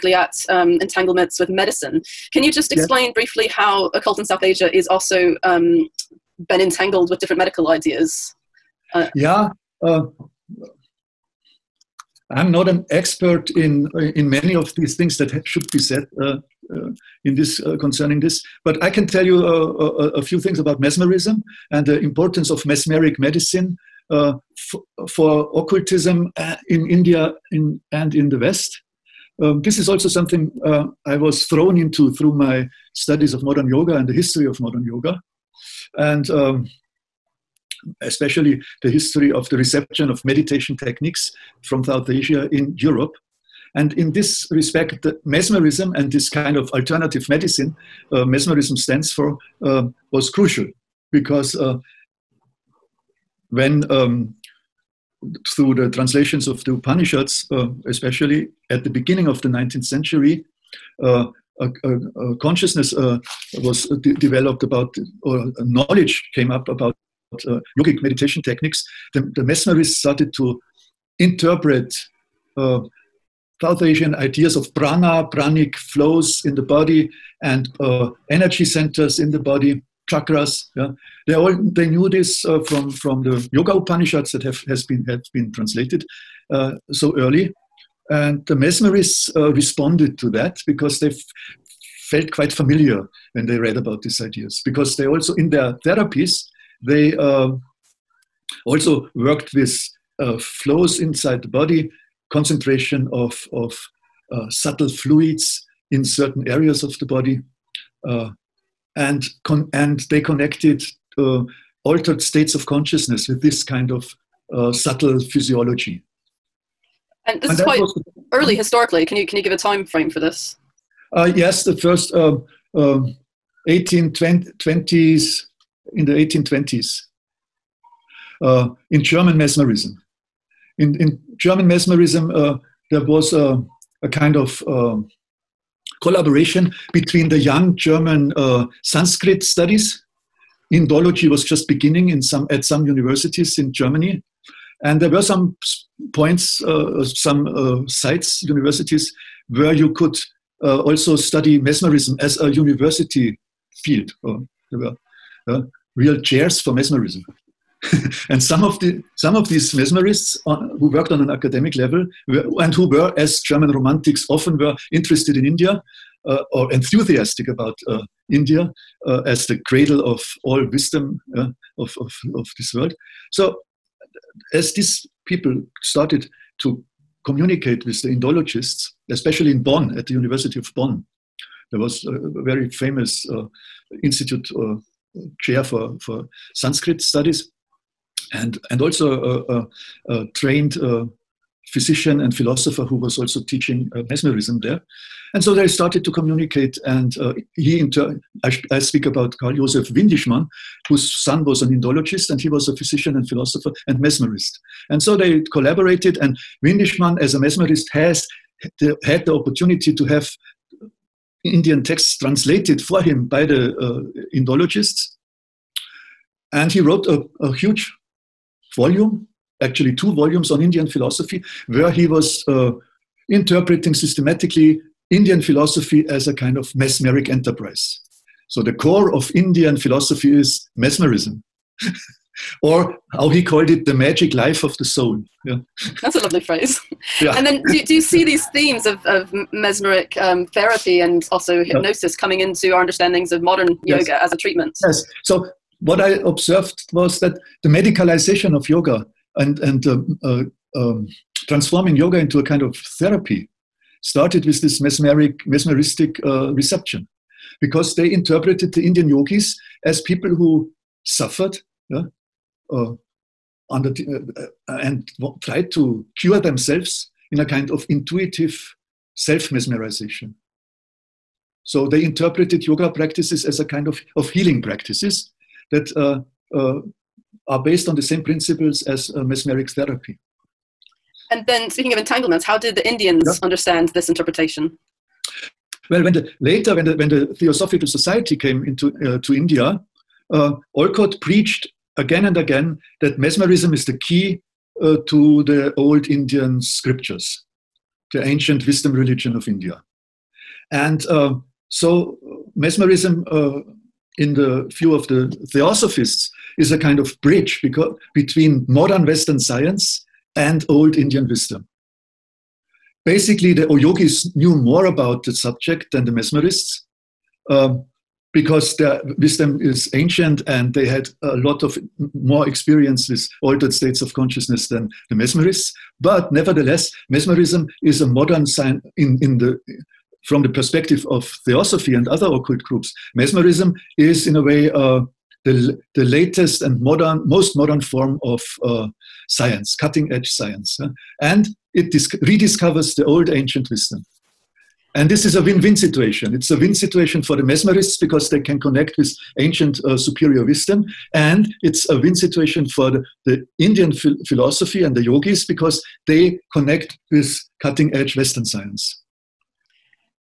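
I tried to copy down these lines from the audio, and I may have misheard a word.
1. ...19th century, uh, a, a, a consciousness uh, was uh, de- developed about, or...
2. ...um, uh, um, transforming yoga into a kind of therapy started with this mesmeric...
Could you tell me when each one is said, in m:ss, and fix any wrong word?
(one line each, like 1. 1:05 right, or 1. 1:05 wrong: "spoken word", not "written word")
1. 0:59 right
2. 4:09 right.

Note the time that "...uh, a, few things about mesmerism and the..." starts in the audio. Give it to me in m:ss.
0:20.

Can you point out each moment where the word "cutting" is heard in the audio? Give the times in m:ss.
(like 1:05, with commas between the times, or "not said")
5:39, 5:57.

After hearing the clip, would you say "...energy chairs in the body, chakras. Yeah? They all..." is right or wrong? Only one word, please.
wrong.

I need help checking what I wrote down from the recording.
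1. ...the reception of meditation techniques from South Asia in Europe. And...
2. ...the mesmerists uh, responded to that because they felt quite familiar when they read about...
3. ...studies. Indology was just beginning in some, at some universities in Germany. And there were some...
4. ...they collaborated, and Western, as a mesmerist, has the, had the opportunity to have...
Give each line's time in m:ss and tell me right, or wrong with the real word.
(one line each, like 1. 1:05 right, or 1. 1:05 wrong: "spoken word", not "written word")
1. 0:39 right
2. 1:28 right
3. 2:19 right
4. 3:25 wrong: "Windischmann", not "Western".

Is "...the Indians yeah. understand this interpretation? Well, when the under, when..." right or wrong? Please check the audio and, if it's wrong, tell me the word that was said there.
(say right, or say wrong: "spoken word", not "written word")
wrong: "later", not "under".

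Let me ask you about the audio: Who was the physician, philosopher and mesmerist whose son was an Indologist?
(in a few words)
Karl Joseph Windischmann.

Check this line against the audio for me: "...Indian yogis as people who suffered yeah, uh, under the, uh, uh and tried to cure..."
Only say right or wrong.
right.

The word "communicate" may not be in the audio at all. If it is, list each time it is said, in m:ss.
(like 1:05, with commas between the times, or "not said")
2:57, 3:16.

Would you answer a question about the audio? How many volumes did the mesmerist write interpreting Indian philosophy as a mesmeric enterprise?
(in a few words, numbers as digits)
2.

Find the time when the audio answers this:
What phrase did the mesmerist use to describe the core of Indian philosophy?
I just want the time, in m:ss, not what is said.
3:53.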